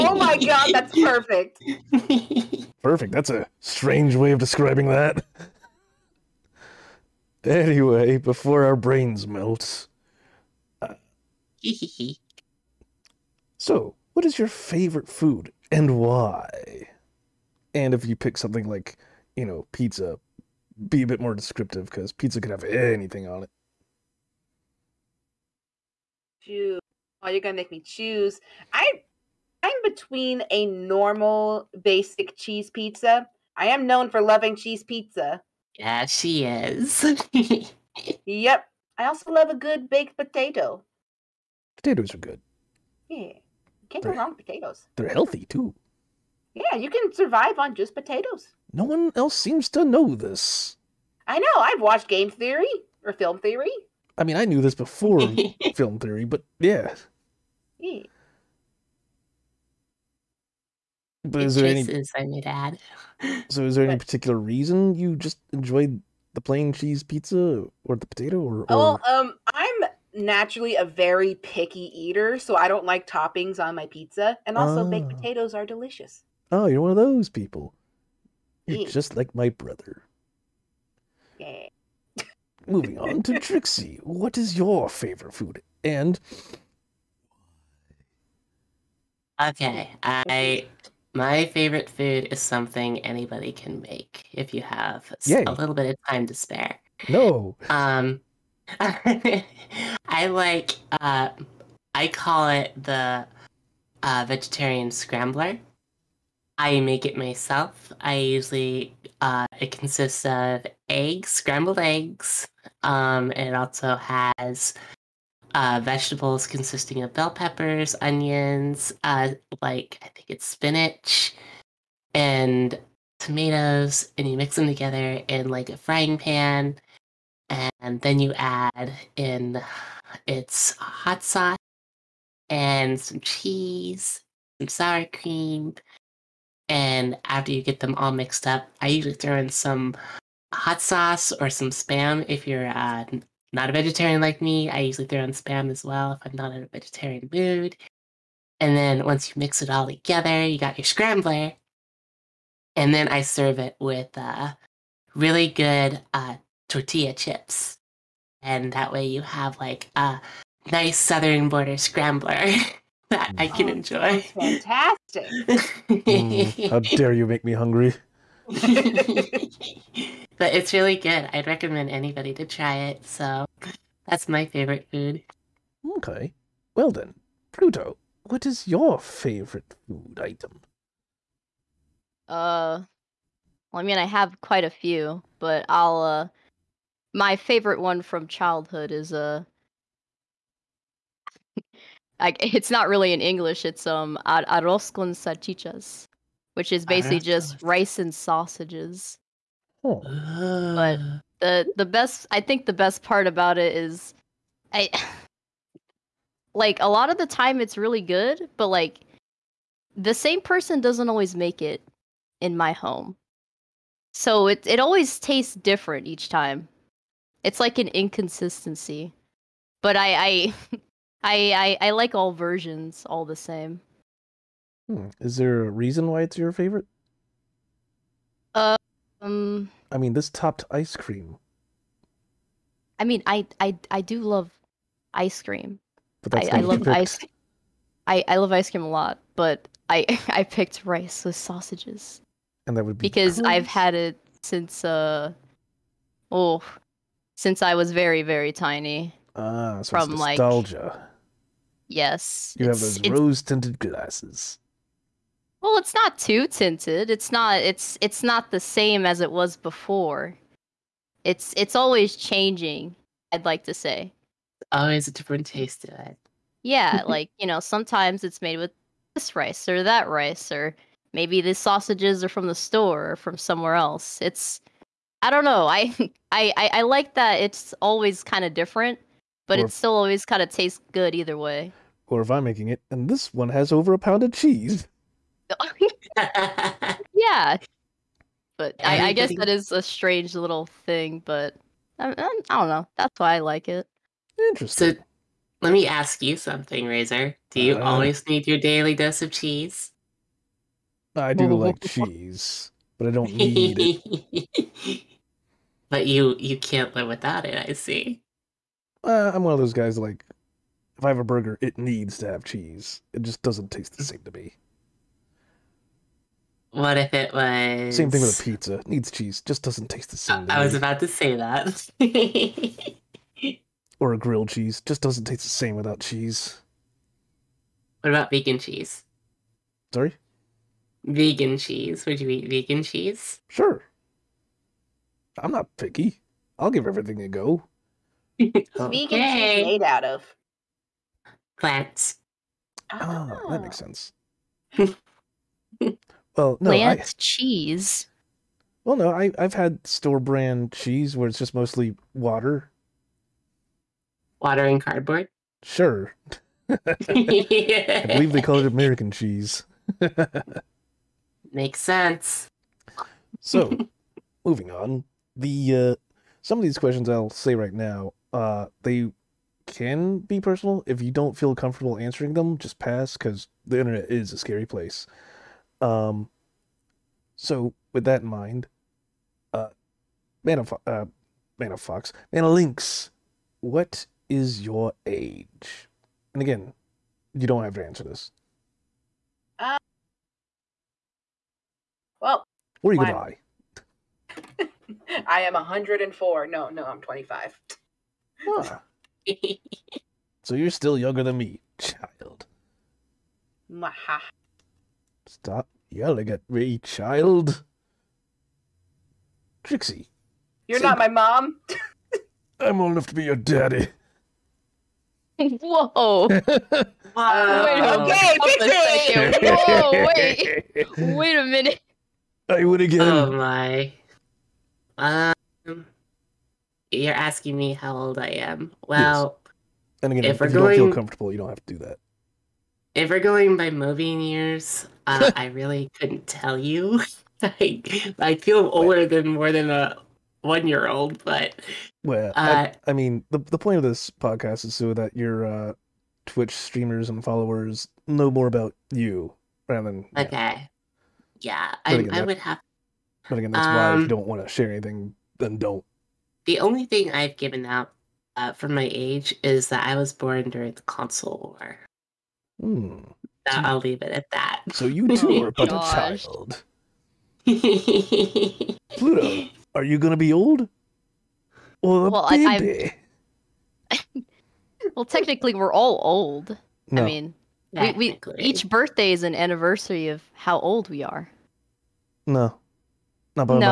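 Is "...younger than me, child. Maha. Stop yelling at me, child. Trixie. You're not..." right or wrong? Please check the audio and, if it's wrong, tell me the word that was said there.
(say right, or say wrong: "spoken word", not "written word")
right.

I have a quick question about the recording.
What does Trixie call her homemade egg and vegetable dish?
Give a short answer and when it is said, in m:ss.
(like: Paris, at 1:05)
Vegetarian scrambler, at 1:44.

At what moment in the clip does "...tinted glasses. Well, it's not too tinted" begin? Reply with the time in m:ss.
4:13.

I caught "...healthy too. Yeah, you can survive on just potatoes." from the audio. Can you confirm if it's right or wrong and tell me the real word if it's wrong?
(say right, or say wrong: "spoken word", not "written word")
right.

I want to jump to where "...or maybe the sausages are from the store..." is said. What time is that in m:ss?
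4:30.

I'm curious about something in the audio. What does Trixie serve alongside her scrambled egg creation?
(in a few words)
Tortilla chips.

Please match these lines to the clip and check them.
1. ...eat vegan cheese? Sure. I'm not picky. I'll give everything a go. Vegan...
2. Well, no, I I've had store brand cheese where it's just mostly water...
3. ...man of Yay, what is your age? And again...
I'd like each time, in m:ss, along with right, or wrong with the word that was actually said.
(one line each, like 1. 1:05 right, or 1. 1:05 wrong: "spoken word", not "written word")
1. 5:32 right
2. 5:48 right
3. 6:22 wrong: "Lynx", not "Yay".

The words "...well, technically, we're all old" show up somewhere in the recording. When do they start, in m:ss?
7:54.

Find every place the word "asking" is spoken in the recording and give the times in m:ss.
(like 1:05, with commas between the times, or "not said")
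7:07.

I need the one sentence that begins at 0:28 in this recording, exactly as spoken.
I I'm between a normal basic cheese pizza.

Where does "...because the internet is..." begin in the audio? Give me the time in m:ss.
6:13.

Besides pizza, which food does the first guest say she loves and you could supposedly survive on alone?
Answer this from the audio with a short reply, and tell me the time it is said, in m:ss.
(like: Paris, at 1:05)
Baked potato, at 0:39.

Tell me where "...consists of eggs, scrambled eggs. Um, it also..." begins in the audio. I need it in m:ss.
1:49.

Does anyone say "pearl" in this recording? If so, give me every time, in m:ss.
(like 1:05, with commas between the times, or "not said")
not said.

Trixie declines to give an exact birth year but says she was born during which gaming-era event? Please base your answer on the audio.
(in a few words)
The console war.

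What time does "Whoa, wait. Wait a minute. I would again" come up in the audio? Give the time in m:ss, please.
6:59.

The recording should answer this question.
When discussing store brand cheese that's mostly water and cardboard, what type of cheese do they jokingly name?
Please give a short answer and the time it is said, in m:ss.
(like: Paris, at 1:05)
American cheese, at 5:58.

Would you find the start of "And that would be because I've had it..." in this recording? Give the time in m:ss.
4:02.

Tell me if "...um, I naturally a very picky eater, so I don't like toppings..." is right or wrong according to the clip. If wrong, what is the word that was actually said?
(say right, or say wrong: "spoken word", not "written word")
right.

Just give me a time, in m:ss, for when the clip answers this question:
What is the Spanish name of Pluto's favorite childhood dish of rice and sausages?
3:14.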